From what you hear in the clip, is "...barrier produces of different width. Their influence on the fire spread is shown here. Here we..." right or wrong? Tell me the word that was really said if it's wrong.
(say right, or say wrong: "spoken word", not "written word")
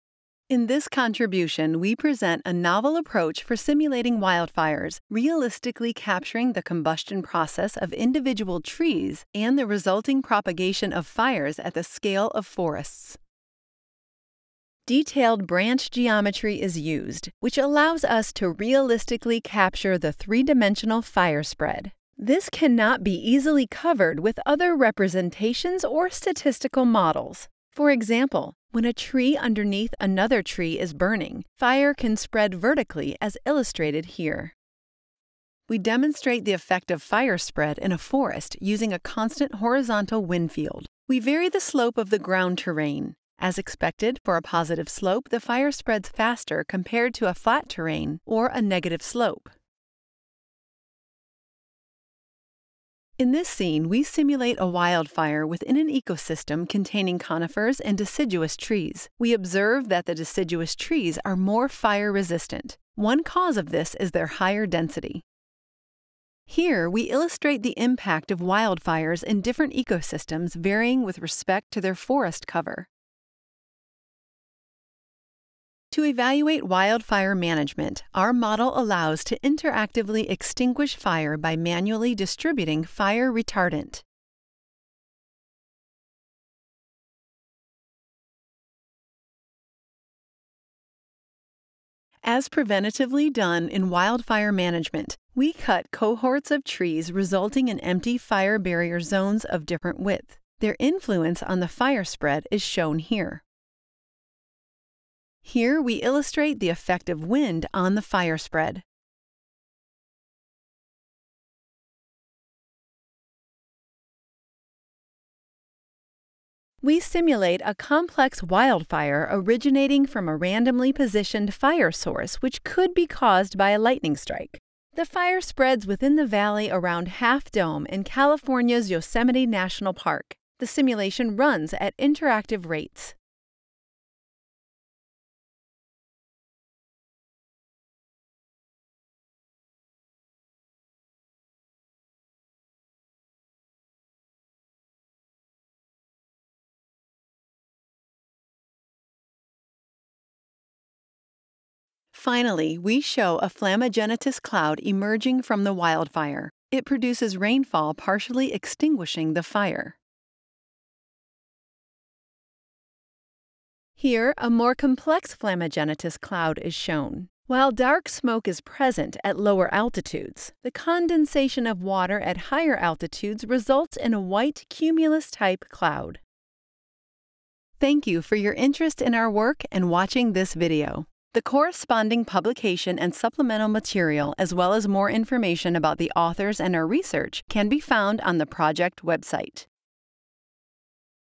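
wrong: "zones", not "produces".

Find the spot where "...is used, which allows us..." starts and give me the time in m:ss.
0:16.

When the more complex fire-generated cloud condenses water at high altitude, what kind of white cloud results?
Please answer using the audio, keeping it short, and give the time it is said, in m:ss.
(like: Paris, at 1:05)
Cumulus-type cloud, at 2:54.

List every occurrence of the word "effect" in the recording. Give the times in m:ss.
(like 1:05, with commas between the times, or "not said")
0:36, 1:46.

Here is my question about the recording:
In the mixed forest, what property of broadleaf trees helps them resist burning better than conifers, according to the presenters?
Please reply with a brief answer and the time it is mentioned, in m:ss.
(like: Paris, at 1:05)
Higher density, at 1:04.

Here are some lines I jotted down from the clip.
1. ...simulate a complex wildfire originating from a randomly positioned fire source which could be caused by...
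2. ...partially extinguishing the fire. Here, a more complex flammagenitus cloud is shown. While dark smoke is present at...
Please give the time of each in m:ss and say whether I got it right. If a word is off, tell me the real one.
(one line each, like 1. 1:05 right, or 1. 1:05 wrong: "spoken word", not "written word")
1. 1:56 right
2. 2:37 right.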